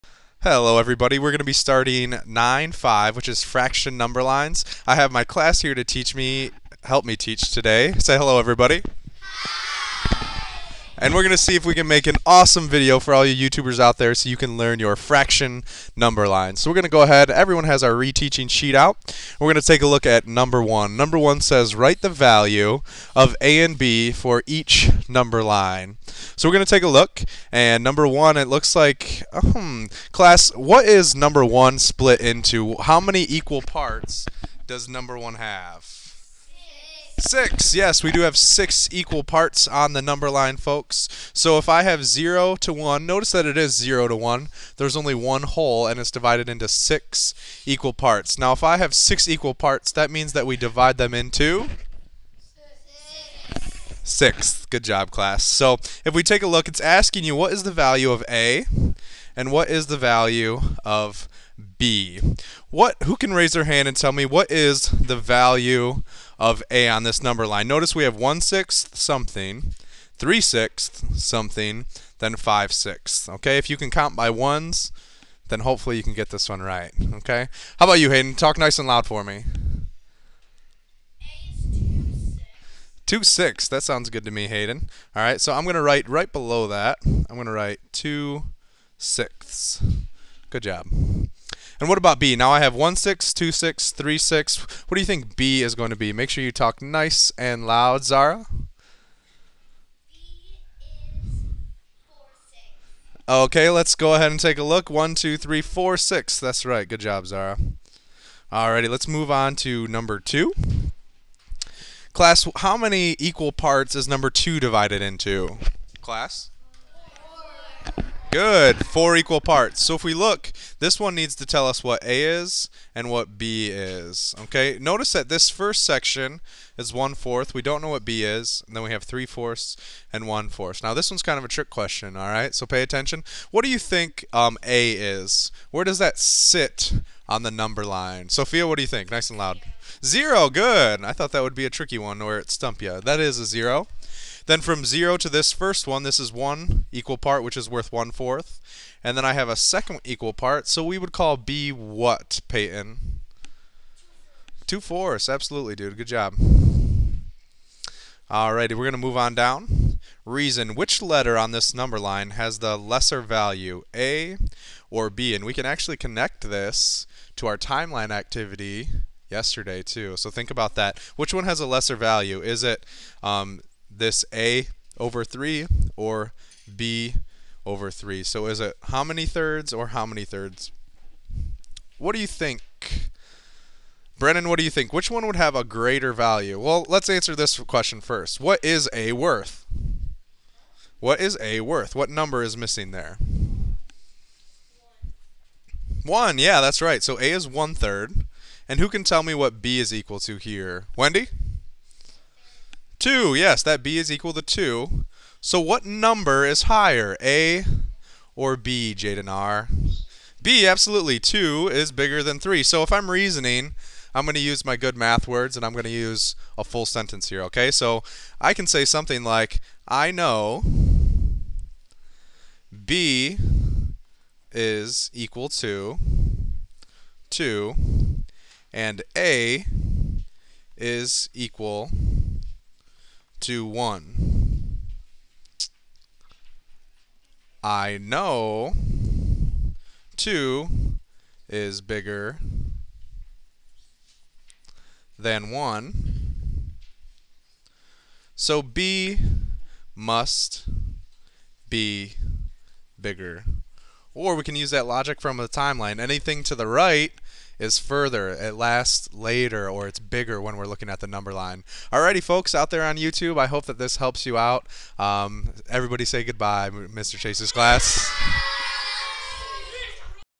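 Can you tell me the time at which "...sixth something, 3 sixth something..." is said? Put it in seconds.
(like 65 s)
68 s.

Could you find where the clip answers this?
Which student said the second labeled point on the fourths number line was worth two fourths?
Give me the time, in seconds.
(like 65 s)
152 s.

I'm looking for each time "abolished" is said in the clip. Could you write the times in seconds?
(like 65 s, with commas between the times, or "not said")
not said.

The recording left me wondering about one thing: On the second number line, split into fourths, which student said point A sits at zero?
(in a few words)
Sophia.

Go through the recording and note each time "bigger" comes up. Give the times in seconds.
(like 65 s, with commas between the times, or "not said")
211 s, 241 s, 252 s, 259 s.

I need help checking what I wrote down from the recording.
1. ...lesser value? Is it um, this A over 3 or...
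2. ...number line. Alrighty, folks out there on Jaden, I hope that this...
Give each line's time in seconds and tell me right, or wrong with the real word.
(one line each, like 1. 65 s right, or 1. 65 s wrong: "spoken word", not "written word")
1. 171 s right
2. 261 s wrong: "YouTube", not "Jaden".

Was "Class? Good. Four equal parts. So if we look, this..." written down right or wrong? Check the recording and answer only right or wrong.
right.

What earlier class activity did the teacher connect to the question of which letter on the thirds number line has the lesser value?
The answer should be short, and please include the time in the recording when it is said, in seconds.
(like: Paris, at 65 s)
timeline activity, at 167 s.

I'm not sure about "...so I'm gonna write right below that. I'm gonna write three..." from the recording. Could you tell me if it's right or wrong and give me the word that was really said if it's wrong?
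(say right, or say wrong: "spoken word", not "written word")
wrong: "two", not "three".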